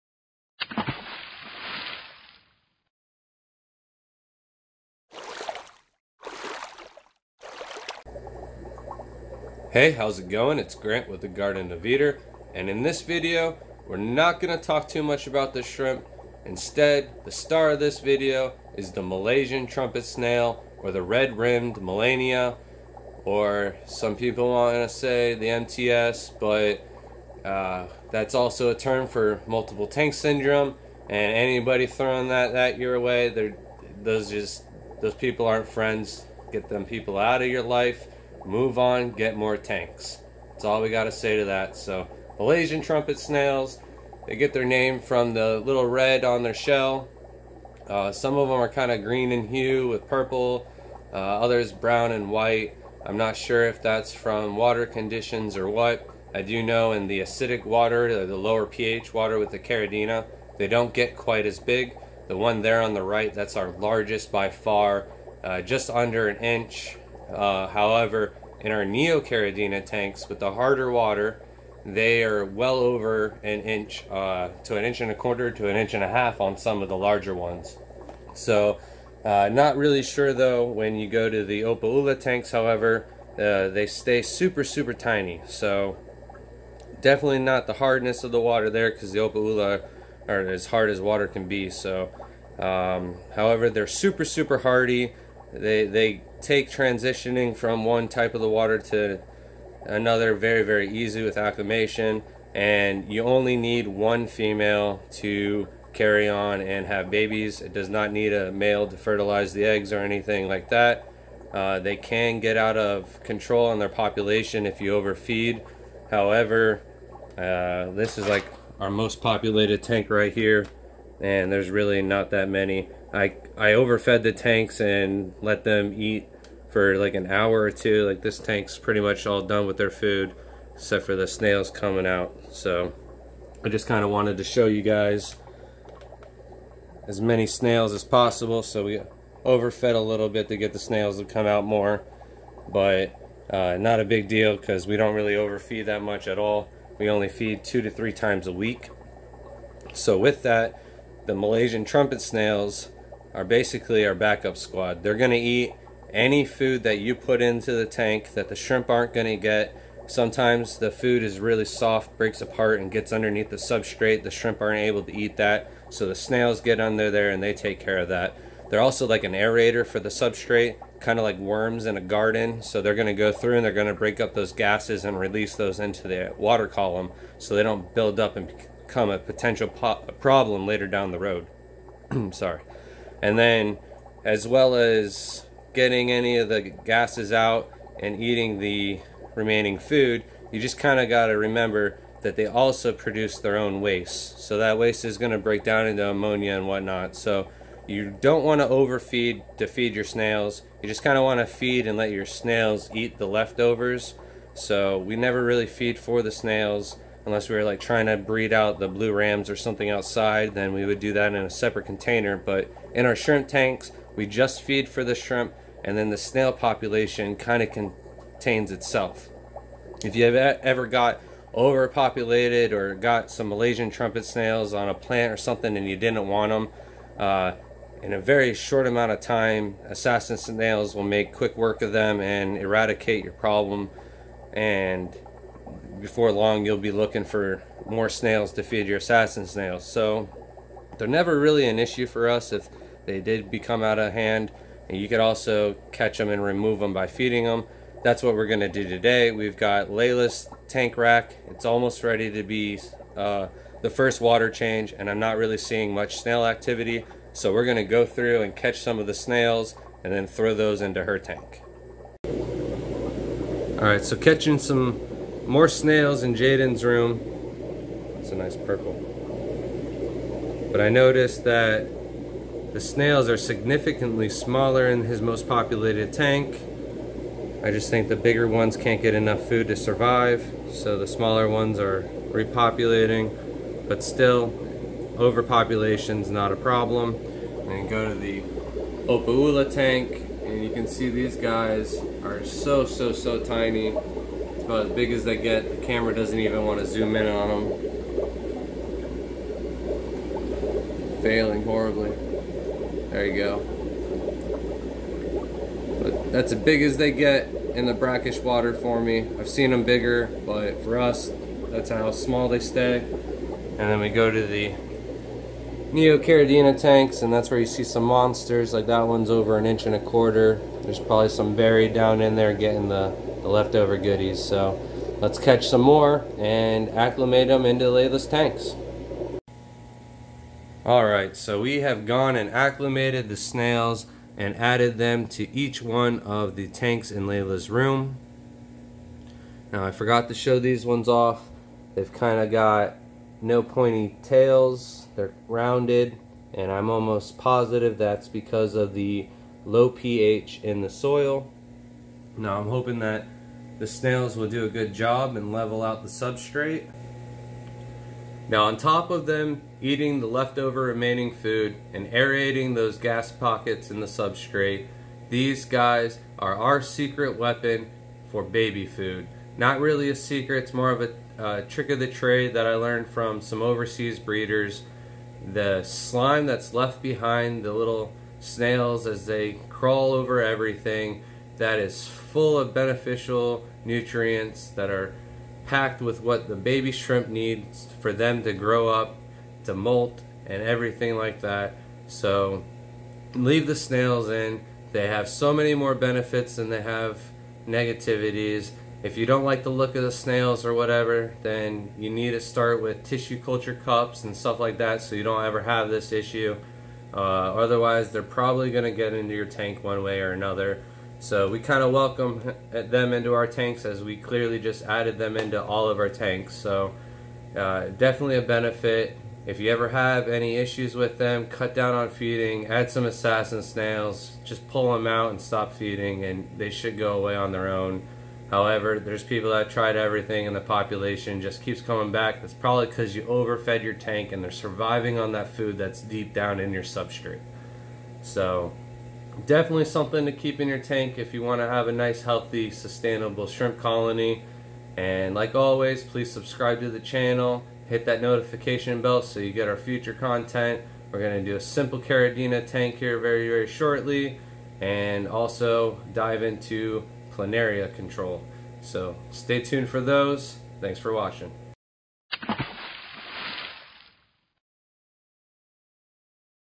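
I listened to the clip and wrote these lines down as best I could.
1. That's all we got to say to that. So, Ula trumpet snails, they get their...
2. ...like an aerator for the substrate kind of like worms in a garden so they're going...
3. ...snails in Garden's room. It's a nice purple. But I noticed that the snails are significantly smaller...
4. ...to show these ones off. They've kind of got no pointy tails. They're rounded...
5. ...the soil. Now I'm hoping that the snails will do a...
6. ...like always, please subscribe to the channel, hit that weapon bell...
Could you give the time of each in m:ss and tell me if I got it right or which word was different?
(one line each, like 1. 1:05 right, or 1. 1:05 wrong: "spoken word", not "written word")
1. 0:40 wrong: "Malaysian", not "Ula"
2. 2:49 right
3. 4:25 wrong: "Jaden", not "Garden"
4. 5:40 right
5. 5:50 right
6. 7:25 wrong: "notification", not "weapon".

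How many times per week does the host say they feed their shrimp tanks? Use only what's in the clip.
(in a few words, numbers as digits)
2 to 3.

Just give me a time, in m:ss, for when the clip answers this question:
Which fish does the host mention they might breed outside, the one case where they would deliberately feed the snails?
3:28.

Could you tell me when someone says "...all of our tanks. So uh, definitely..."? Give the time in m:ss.
6:55.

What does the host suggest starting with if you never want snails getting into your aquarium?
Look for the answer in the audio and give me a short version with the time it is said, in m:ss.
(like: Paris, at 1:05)
tissue culture cups, at 6:43.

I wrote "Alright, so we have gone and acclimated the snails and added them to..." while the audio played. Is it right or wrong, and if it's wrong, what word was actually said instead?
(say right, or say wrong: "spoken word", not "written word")
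right.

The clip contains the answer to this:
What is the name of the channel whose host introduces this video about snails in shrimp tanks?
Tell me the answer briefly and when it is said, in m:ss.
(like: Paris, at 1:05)
Garden of Eder, at 0:11.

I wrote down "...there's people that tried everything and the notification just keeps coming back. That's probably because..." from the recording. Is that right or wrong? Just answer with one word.
wrong.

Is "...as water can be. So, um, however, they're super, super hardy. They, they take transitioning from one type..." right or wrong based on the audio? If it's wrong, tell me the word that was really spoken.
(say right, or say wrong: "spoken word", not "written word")
right.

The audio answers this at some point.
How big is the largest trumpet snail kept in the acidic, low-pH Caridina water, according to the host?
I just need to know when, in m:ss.
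1:05.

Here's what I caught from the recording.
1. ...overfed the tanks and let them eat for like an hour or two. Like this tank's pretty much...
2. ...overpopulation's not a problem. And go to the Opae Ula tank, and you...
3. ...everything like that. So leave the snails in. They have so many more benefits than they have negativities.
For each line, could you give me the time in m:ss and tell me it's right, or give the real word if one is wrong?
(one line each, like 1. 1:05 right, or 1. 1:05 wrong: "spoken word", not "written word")
1. 2:03 right
2. 4:45 right
3. 6:30 right.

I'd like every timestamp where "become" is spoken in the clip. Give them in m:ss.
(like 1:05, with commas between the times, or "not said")
2:58, 4:03.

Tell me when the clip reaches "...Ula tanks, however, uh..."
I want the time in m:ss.
1:21.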